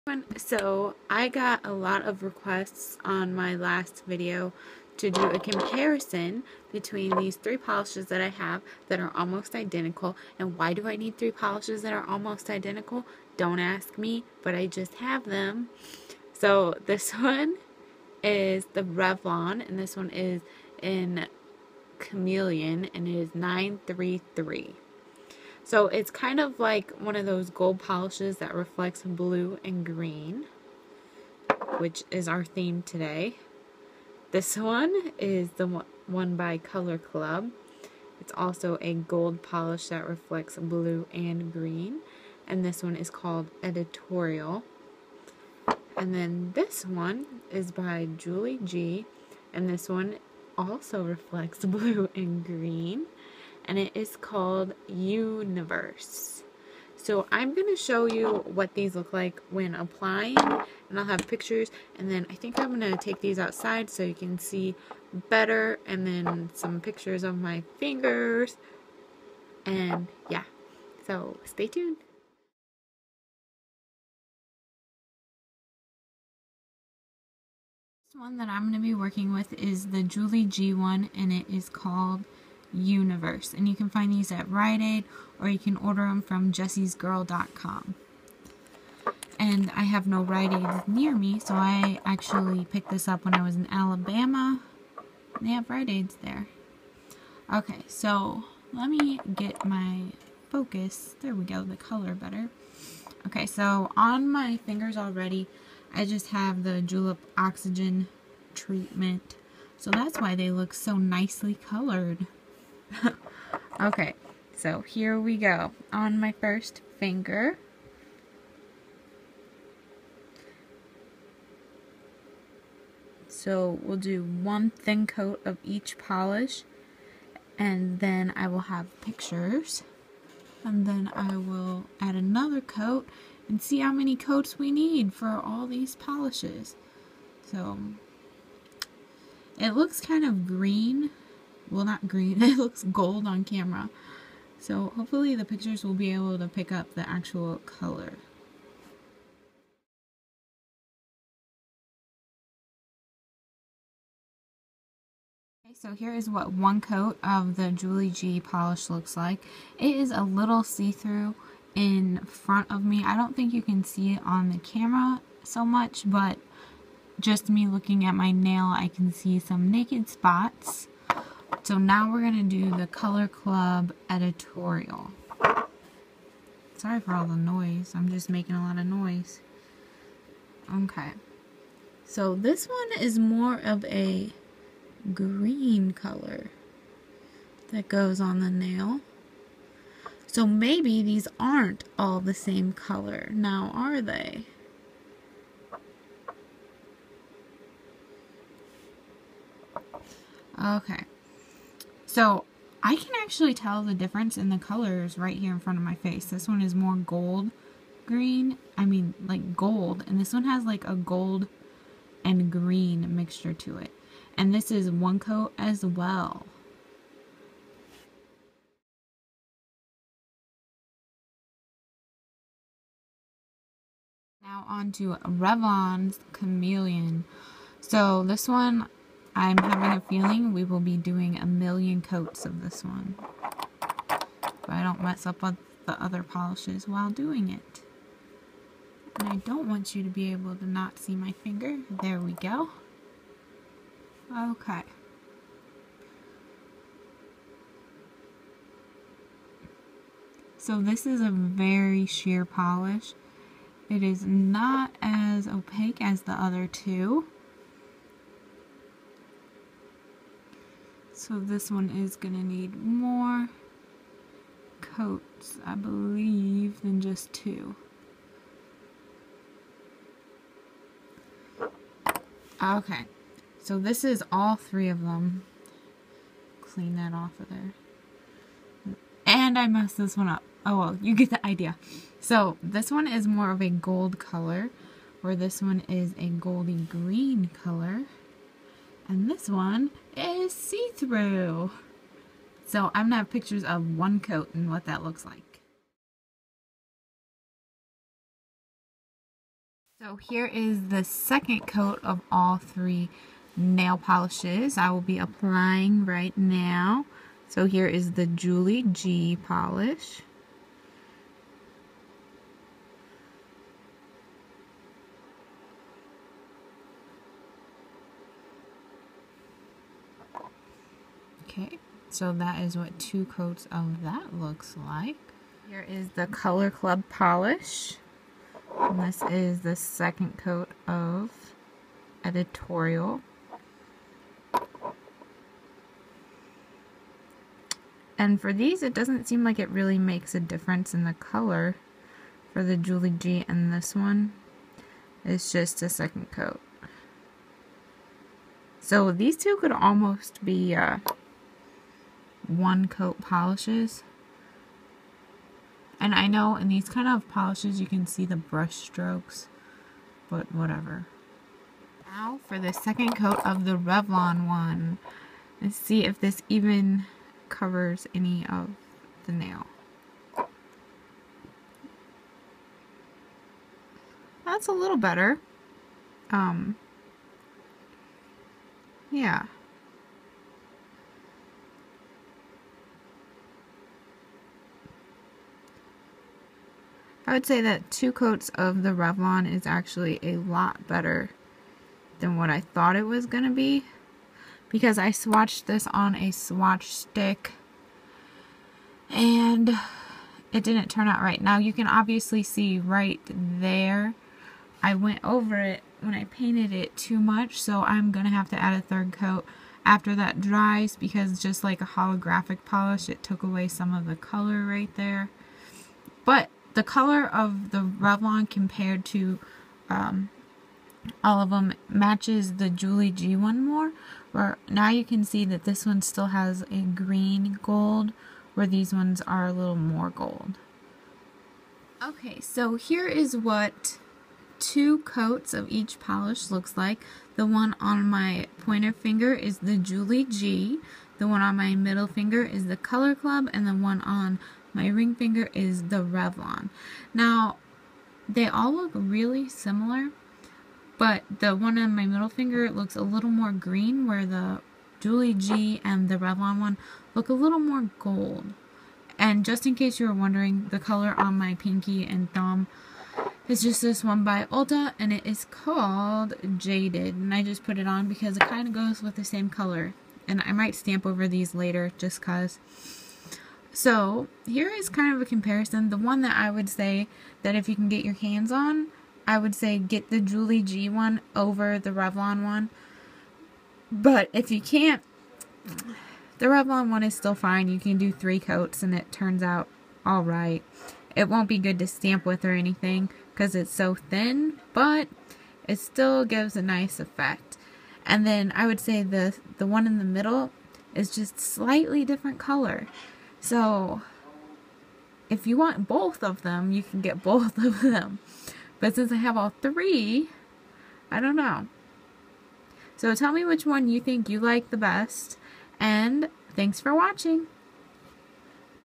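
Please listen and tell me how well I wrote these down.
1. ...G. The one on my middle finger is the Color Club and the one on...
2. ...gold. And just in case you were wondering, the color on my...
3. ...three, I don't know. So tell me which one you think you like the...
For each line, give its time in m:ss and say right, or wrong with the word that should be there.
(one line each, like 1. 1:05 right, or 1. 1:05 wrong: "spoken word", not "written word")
1. 7:20 right
2. 7:37 right
3. 8:29 right.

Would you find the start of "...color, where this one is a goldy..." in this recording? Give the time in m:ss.
4:44.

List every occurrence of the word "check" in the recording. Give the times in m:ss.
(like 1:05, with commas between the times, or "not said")
not said.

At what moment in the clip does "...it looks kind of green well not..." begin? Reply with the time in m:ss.
2:19.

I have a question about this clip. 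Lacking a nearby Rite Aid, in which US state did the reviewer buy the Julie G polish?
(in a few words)
Alabama.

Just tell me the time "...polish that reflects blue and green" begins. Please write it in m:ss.
0:39.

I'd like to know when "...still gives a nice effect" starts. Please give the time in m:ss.
8:15.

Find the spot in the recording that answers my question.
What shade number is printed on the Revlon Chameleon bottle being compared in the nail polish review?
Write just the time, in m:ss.
0:23.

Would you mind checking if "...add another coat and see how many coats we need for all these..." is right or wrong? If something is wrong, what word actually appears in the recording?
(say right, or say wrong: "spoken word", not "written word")
right.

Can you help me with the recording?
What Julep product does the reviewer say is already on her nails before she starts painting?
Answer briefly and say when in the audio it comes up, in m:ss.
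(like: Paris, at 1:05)
Oxygen treatment, at 1:47.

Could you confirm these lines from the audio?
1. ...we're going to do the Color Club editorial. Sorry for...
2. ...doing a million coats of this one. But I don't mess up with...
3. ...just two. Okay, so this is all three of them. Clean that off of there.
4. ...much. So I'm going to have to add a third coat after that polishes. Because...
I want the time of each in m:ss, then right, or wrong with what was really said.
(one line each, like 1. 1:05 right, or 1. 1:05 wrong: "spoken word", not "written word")
1. 2:52 right
2. 3:50 right
3. 4:26 right
4. 6:47 wrong: "dries", not "polishes".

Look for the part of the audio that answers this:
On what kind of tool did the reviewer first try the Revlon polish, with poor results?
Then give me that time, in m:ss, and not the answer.
6:36.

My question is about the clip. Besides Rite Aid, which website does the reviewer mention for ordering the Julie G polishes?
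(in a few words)
jessesgirl.com.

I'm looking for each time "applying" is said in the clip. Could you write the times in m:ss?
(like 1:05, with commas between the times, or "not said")
0:59, 5:05.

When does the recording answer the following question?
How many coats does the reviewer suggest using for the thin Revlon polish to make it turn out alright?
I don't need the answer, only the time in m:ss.
8:08.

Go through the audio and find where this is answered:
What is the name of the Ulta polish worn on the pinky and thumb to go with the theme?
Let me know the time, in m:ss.
7:46.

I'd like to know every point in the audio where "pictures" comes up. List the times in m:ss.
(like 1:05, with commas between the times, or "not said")
1:01, 1:06, 2:09, 2:25, 4:53.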